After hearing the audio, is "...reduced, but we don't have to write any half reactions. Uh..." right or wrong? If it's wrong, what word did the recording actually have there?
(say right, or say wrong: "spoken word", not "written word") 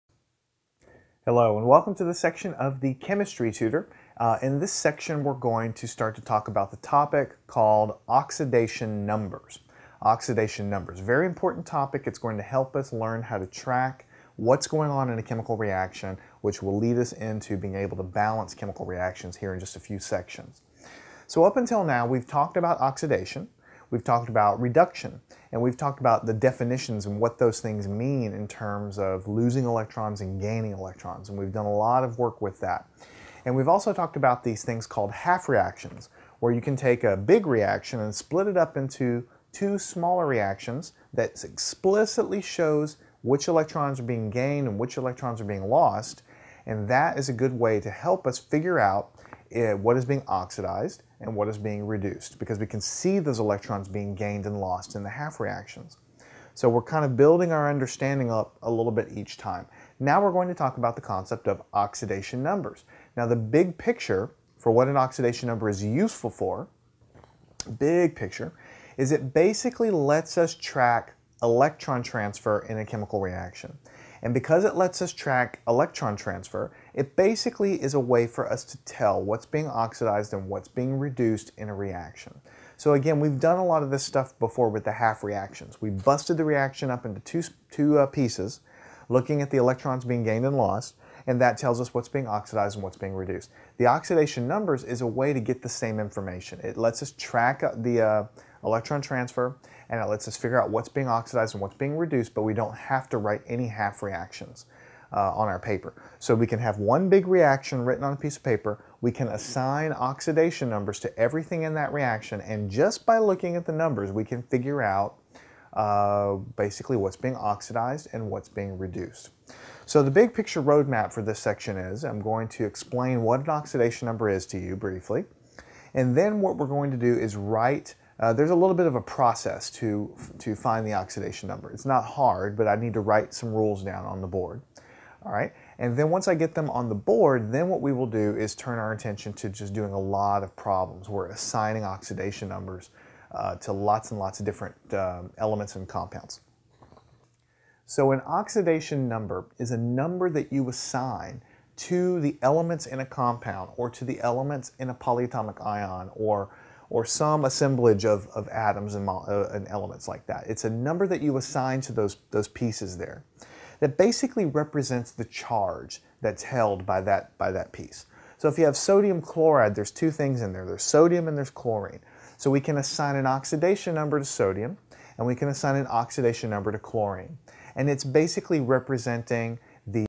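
right.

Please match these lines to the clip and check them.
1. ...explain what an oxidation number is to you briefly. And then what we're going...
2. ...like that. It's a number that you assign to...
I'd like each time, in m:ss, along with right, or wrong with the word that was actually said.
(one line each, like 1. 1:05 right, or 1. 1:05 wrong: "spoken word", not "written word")
1. 2:02 right
2. 2:40 right.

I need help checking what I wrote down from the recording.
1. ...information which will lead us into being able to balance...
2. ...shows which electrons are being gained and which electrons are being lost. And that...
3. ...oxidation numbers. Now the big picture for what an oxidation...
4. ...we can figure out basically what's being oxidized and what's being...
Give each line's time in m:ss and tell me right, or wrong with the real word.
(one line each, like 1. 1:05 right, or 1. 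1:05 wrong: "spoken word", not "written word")
1. 0:15 wrong: "reaction", not "information"
2. 0:42 right
3. 1:01 right
4. 1:54 right.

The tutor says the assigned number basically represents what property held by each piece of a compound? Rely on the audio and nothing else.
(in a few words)
The charge.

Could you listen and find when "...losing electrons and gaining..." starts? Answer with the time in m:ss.
0:29.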